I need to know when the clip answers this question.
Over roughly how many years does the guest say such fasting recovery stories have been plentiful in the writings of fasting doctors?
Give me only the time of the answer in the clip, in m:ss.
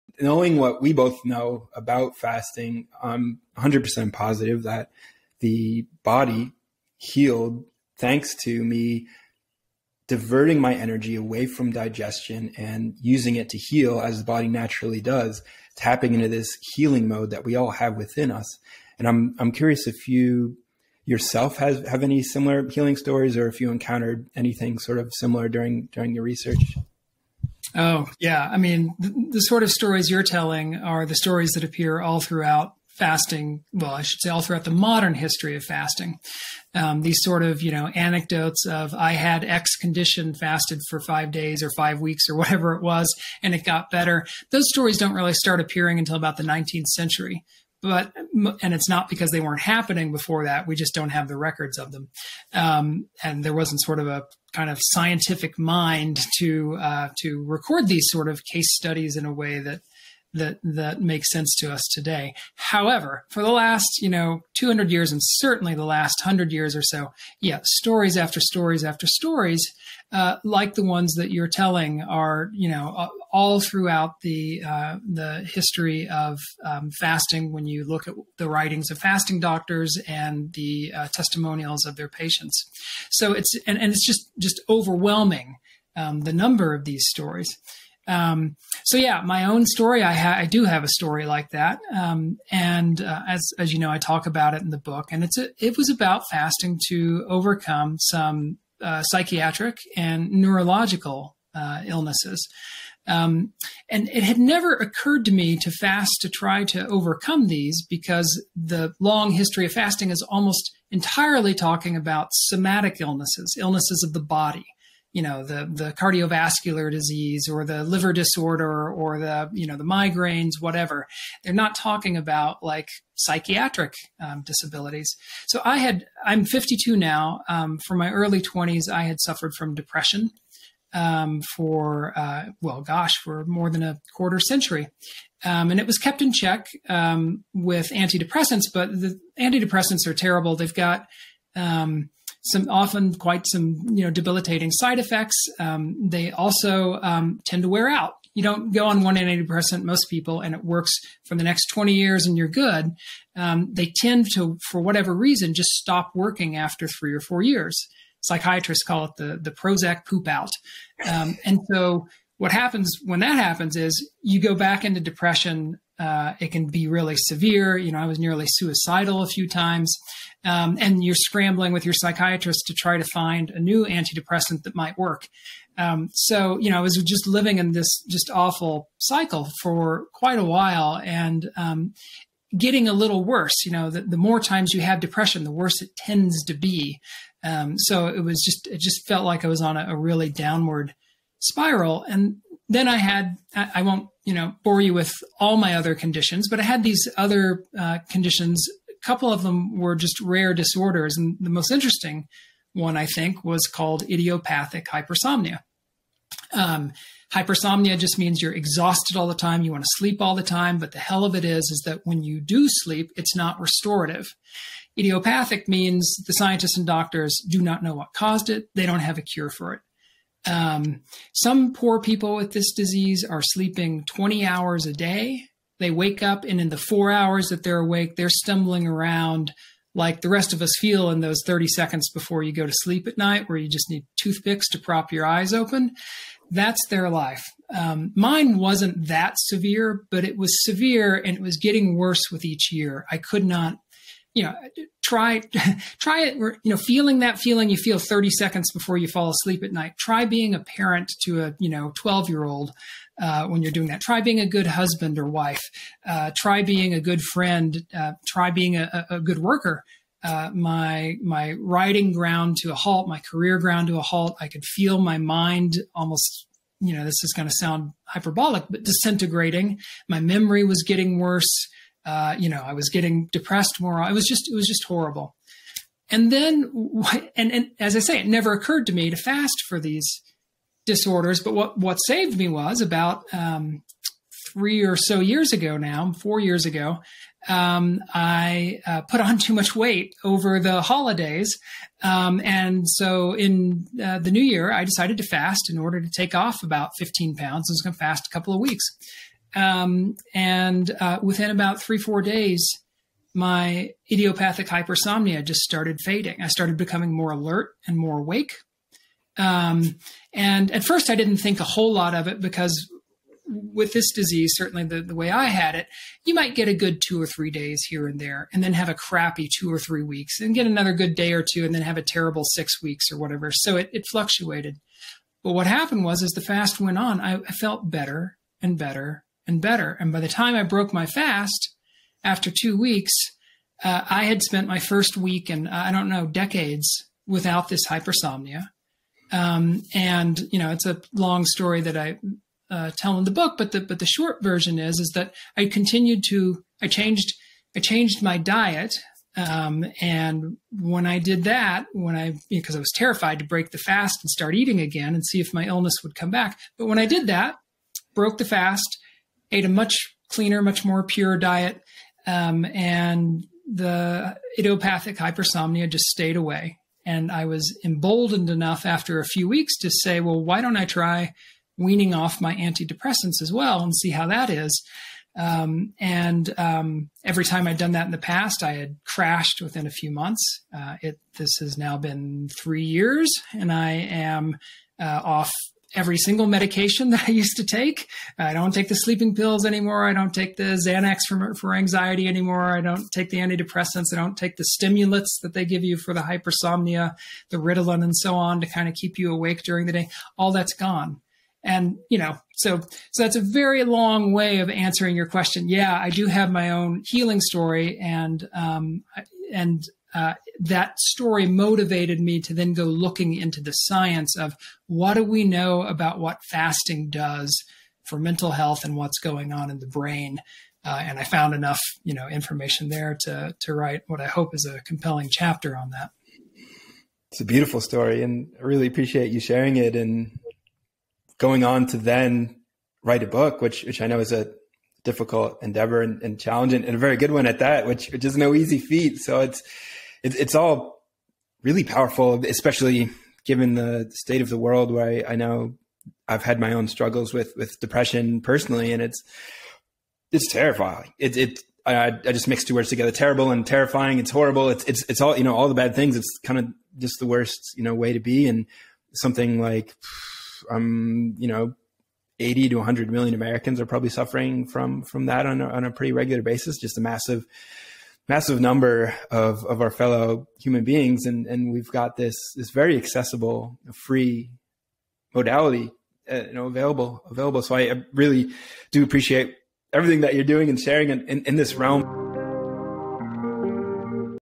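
1:04.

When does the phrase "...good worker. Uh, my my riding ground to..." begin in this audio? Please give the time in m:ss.
4:19.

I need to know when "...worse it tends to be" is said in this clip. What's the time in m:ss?
3:05.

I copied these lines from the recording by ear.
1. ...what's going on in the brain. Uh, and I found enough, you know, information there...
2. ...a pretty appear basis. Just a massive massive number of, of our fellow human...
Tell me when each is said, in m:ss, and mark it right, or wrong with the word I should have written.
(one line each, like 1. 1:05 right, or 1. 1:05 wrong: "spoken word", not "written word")
1. 6:58 right
2. 7:45 wrong: "regular", not "appear".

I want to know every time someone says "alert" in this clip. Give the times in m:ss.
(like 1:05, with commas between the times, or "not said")
5:07.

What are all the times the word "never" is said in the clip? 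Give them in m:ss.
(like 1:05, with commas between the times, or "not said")
1:44, 4:38.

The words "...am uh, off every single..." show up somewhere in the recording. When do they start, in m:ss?
6:23.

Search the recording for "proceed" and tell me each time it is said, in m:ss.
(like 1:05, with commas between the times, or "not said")
not said.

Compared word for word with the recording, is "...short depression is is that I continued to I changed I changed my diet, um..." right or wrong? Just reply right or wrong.
wrong.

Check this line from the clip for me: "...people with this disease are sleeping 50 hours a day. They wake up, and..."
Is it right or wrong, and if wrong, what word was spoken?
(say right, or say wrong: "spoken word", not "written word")
wrong: "20", not "50".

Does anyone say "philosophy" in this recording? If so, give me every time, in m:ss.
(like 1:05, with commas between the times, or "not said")
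not said.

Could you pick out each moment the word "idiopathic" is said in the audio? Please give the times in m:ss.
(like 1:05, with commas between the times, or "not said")
3:24, 3:34, 5:04, 6:04.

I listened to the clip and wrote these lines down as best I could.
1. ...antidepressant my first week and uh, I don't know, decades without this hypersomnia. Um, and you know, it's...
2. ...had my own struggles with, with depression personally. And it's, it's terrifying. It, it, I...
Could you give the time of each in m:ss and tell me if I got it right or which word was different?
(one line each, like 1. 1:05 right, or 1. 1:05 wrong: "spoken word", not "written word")
1. 5:34 wrong: "spent", not "antidepressant"
2. 7:26 right.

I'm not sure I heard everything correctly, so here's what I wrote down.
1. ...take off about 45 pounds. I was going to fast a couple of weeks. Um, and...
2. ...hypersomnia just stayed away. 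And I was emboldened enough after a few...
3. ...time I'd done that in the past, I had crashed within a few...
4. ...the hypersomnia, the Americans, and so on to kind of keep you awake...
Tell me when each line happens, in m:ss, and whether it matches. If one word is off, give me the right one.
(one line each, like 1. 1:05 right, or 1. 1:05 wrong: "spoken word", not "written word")
1. 4:56 wrong: "15", not "45"
2. 6:05 right
3. 6:17 right
4. 6:36 wrong: "Ritalin", not "Americans".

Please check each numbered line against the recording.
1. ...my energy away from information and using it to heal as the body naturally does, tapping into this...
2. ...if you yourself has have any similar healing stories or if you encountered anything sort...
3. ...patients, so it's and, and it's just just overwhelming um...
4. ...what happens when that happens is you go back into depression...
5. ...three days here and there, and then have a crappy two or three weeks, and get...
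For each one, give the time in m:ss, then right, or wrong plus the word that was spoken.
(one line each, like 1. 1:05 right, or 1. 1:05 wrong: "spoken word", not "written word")
1. 0:10 wrong: "digestion", not "information"
2. 0:19 right
3. 1:22 right
4. 2:42 right
5. 5:17 right.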